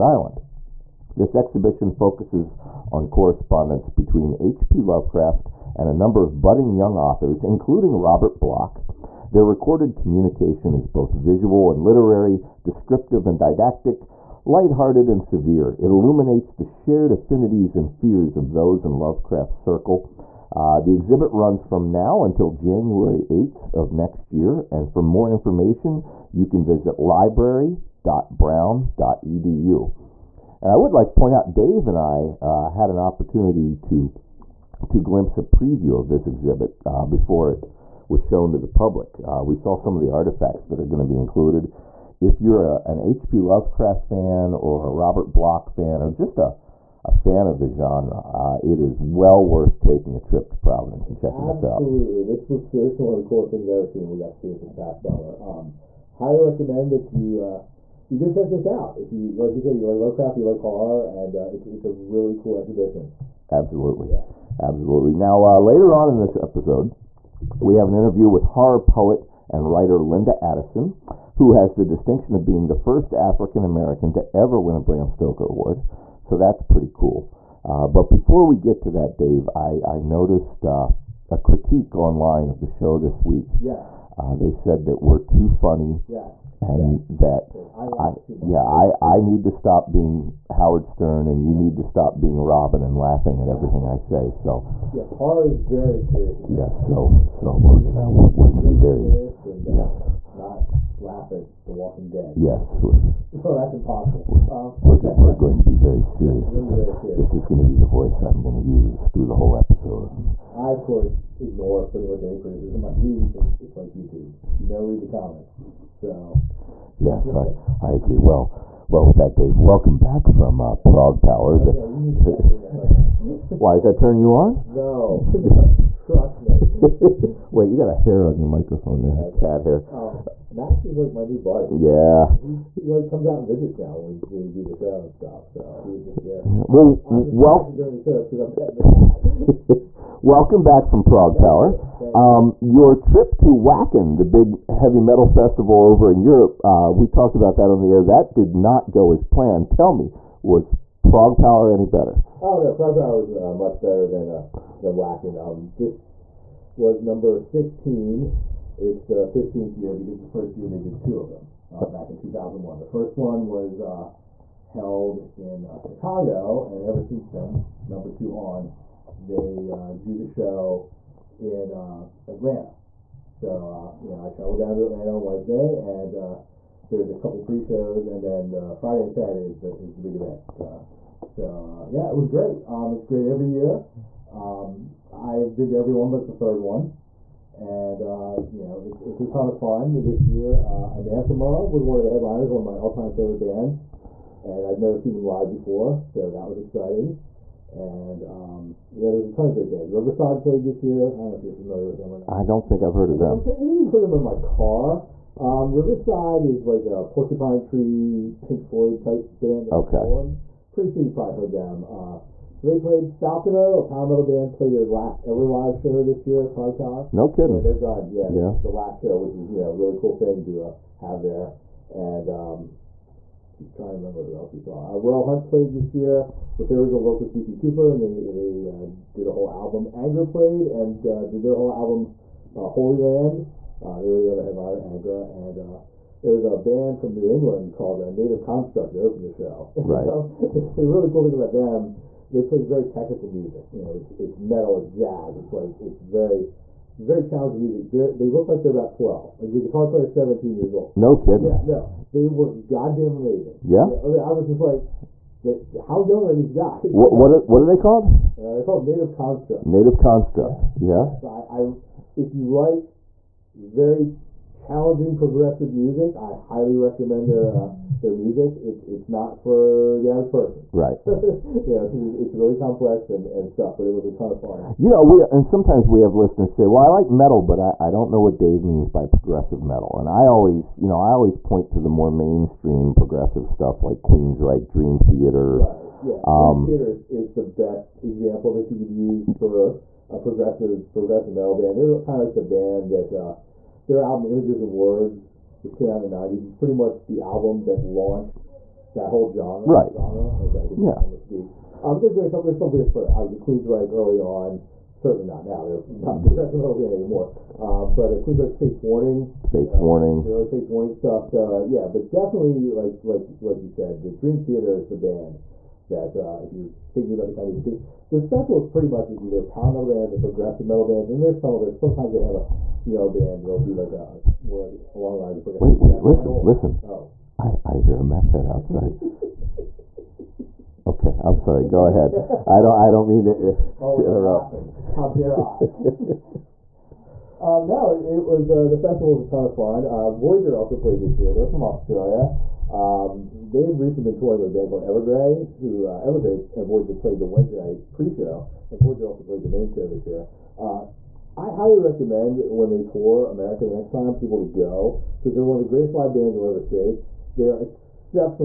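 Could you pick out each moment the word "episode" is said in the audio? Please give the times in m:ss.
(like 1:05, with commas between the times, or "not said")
1:06, 1:49.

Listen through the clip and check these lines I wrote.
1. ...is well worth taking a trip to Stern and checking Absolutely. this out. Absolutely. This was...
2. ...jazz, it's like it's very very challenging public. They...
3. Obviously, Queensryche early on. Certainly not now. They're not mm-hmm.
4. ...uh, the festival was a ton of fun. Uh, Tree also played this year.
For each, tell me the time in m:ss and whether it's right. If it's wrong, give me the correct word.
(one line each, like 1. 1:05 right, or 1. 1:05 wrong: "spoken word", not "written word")
1. 0:48 wrong: "Providence", not "Stern"
2. 4:04 wrong: "music", not "public"
3. 5:03 right
4. 5:38 wrong: "Voyager", not "Tree".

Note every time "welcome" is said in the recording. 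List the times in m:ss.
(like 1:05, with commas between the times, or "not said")
1:59, 2:20.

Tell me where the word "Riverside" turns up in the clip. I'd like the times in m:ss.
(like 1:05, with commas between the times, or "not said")
3:19, 3:25.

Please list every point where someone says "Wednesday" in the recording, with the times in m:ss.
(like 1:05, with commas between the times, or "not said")
2:55, 5:47.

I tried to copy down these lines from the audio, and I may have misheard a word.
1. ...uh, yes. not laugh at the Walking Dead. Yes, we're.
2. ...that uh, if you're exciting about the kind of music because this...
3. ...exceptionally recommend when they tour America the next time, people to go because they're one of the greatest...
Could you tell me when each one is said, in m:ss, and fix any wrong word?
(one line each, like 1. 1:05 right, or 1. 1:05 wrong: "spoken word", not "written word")
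1. 1:39 right
2. 5:15 wrong: "thinking", not "exciting"
3. 5:51 wrong: "highly", not "exceptionally".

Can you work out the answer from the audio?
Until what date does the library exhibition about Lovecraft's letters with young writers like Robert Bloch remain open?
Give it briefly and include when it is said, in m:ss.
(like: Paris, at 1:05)
January 8, at 0:22.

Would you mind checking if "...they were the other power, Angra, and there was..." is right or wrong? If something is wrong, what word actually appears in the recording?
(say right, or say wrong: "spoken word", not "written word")
wrong: "headliner", not "power".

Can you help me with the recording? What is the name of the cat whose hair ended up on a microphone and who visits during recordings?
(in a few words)
Max.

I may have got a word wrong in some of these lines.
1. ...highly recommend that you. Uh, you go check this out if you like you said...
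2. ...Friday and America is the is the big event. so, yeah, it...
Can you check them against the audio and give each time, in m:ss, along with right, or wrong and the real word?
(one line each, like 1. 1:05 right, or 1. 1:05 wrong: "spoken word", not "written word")
1. 0:56 right
2. 2:58 wrong: "Saturday", not "America".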